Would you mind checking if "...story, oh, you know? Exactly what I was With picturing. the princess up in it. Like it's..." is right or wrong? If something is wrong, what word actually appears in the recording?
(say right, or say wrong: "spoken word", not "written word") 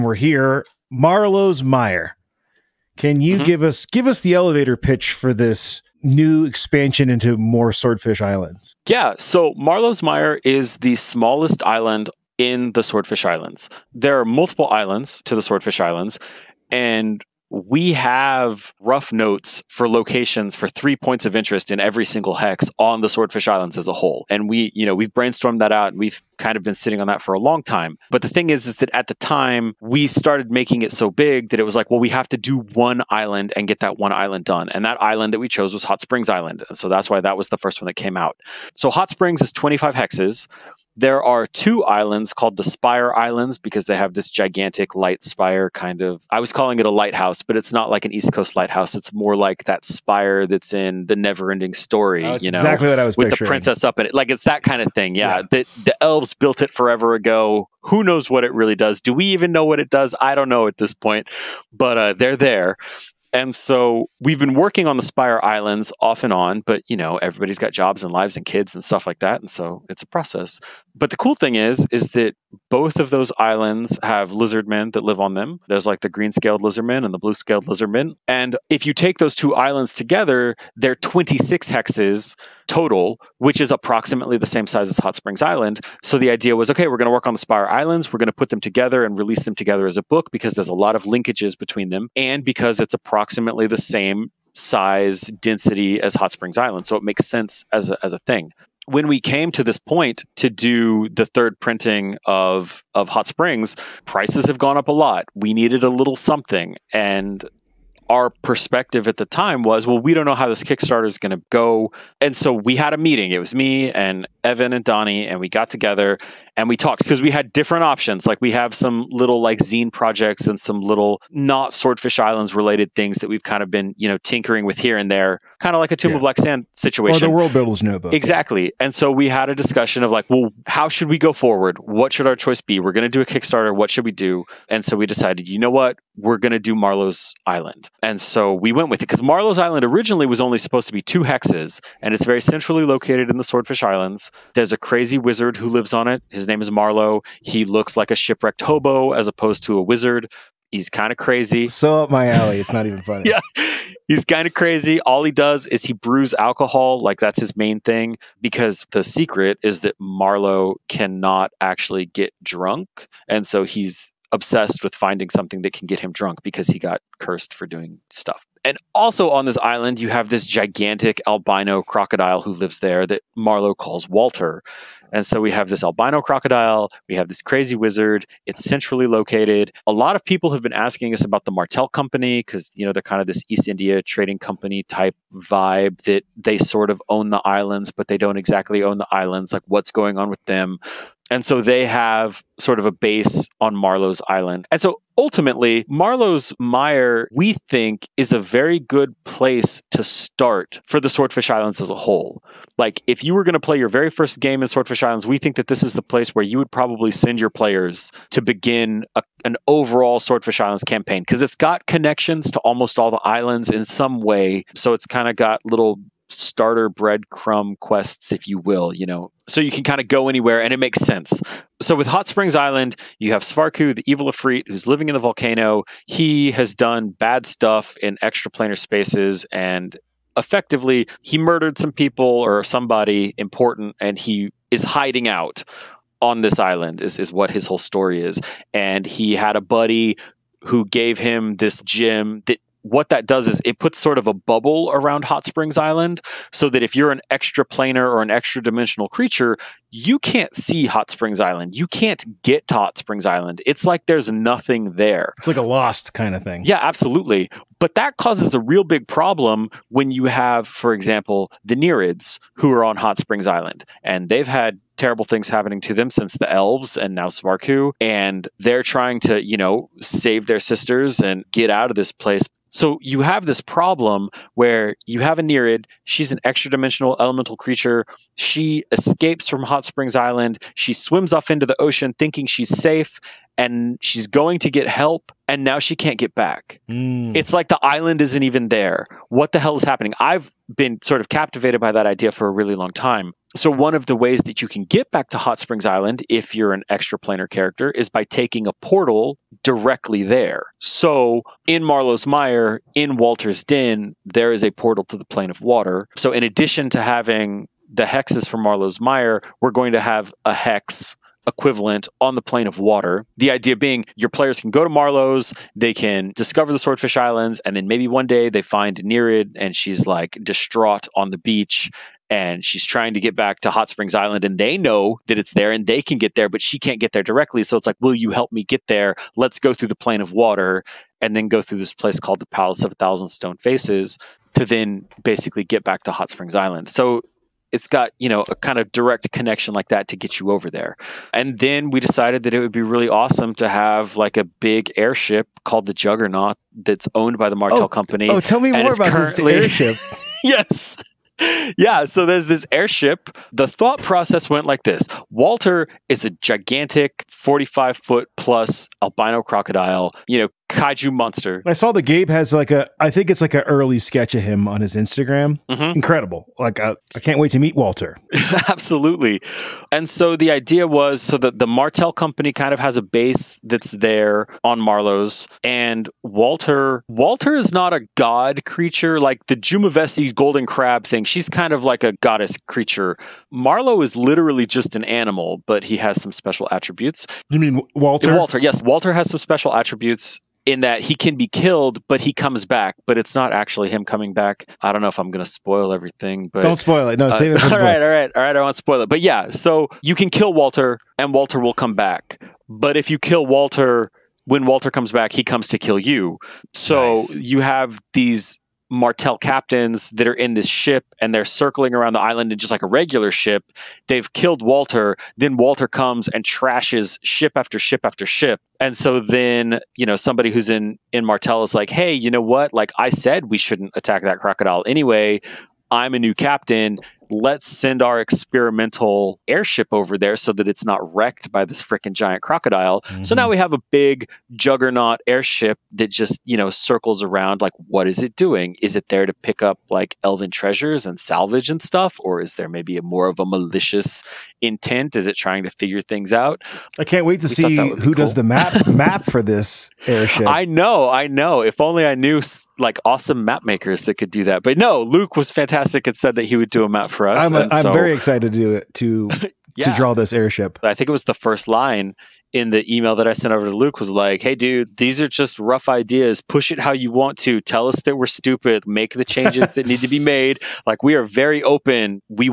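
right.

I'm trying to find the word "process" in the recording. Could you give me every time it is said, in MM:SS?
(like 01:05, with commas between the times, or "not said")
01:10, 05:54.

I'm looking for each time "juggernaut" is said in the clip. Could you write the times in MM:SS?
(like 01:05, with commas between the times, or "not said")
05:45, 07:14.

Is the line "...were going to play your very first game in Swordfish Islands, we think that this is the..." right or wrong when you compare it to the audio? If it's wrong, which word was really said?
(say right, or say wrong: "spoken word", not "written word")
right.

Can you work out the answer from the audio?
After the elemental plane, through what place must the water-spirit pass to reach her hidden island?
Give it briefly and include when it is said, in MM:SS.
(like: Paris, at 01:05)
Palace of a Thousand Stone Faces, at 05:32.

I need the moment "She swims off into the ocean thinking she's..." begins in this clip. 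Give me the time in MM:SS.
04:40.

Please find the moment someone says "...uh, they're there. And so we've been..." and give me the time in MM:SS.
01:01.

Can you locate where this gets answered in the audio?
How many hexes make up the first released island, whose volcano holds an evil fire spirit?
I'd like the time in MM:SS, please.
00:39.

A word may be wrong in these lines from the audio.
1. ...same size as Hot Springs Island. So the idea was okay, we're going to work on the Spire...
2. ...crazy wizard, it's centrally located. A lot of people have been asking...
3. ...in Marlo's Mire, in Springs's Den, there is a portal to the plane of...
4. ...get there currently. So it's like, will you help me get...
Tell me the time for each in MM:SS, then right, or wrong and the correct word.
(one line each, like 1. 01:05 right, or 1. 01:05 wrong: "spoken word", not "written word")
1. 01:24 right
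2. 02:57 right
3. 05:01 wrong: "Walter", not "Springs"
4. 05:26 wrong: "directly", not "currently".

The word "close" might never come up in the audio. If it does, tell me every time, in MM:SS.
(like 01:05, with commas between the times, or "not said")
not said.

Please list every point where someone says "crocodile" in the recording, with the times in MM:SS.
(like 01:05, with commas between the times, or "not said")
02:51, 02:56, 05:59, 07:04, 07:12.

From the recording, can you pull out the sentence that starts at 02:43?
And so he's obsessed with finding something that can get him drunk because he got cursed for doing stuff.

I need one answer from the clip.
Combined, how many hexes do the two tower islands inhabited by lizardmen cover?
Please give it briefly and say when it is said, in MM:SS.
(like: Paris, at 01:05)
26, at 01:20.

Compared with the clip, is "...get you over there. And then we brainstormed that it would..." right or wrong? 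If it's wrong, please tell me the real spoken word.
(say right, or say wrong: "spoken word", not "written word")
wrong: "decided", not "brainstormed".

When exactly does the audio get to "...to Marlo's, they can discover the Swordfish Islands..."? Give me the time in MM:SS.
05:14.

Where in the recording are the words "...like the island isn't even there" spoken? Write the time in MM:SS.
04:47.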